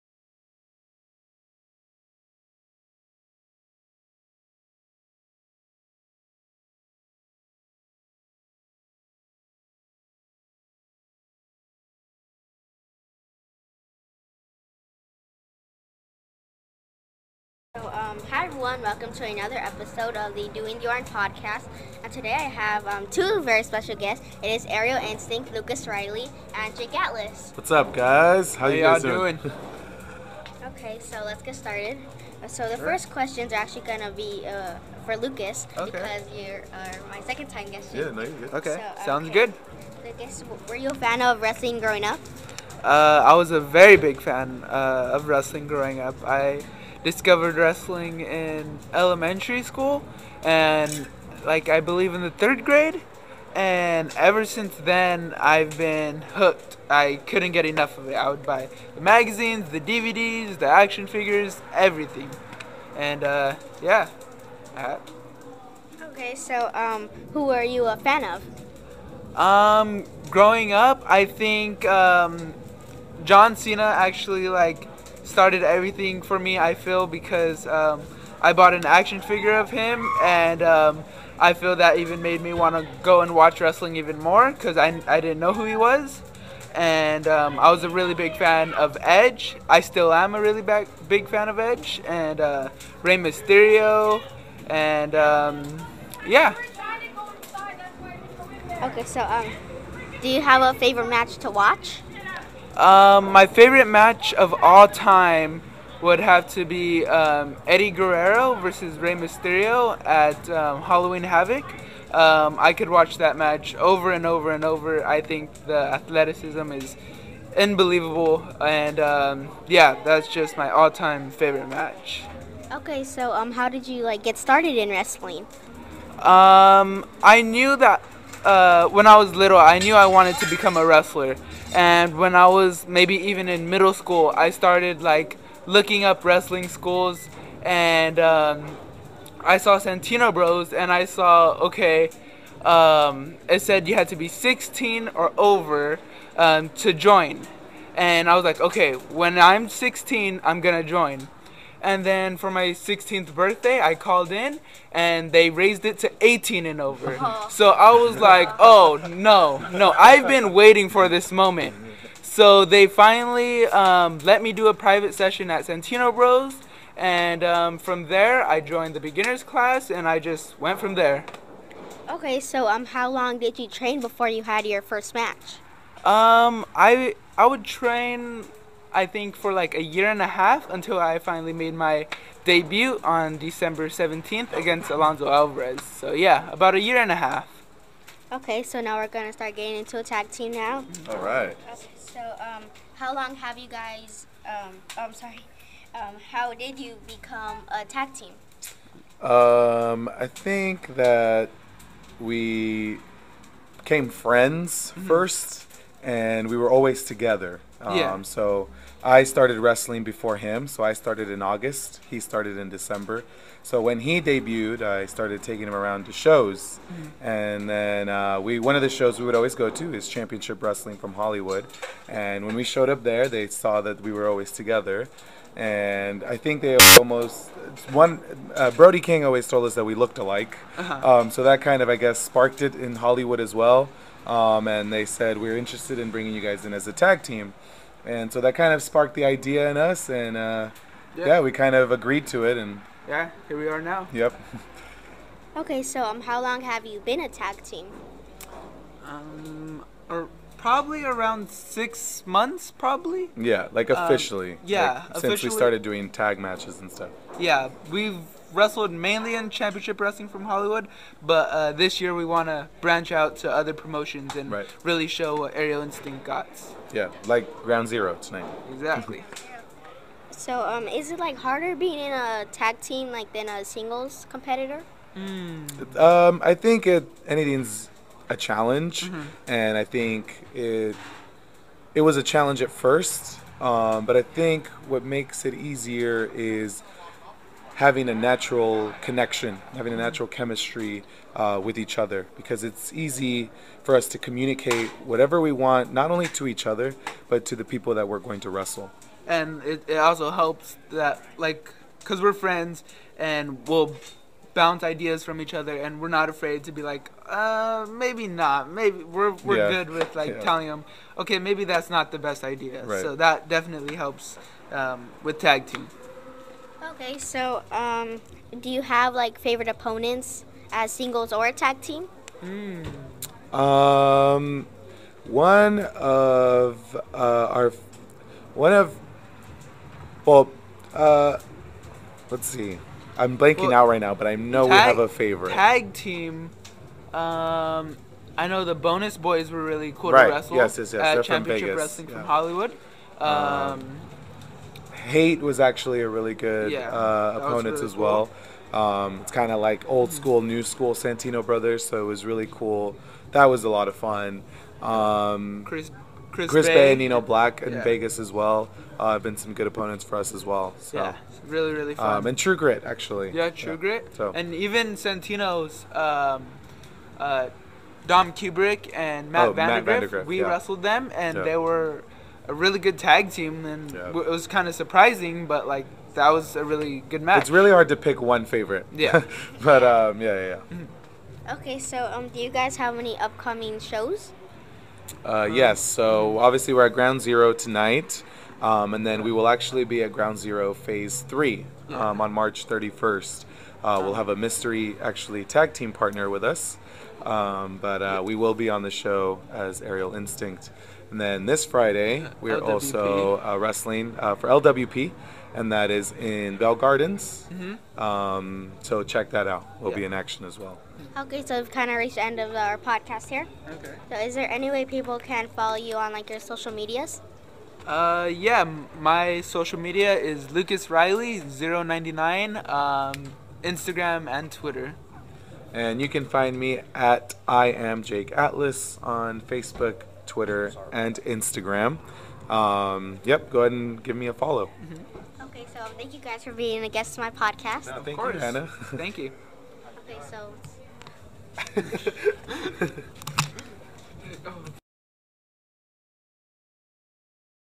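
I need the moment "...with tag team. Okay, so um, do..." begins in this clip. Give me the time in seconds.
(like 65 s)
315 s.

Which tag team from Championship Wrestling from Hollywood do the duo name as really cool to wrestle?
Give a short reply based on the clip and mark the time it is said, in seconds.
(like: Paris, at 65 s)
Bonus Boys, at 338 s.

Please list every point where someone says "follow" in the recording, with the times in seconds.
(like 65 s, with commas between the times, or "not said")
415 s, 434 s.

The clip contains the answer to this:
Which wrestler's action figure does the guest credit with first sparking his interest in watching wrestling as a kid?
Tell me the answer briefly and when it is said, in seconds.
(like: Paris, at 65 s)
John Cena, at 73 s.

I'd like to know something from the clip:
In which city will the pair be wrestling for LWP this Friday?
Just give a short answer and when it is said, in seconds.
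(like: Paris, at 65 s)
Bell Gardens, at 406 s.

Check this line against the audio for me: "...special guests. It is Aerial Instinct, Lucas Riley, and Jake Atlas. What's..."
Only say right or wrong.
right.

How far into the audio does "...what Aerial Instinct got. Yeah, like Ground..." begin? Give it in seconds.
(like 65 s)
265 s.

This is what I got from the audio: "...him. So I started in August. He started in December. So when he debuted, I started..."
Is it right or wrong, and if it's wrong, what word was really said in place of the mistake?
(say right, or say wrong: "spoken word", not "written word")
right.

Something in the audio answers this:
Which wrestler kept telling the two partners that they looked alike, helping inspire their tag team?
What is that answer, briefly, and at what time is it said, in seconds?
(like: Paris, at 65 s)
Brody King, at 228 s.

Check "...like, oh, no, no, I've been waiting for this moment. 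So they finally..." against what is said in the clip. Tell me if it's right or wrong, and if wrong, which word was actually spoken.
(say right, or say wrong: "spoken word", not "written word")
right.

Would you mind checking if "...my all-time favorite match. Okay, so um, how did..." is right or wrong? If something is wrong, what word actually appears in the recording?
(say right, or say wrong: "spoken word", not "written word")
right.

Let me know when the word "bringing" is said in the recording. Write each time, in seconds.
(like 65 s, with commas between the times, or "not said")
236 s.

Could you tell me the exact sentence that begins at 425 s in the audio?
And you can find me at I am Jake Atlas on Facebook, Twitter, and Instagram.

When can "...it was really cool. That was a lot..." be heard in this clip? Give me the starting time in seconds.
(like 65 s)
352 s.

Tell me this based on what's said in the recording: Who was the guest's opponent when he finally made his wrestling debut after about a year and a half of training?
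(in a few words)
Alonso Alvarez.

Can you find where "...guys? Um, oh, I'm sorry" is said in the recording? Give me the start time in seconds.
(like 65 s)
193 s.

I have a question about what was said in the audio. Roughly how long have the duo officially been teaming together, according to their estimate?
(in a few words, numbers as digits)
6 months.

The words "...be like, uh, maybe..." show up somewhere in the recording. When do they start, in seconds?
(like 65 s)
306 s.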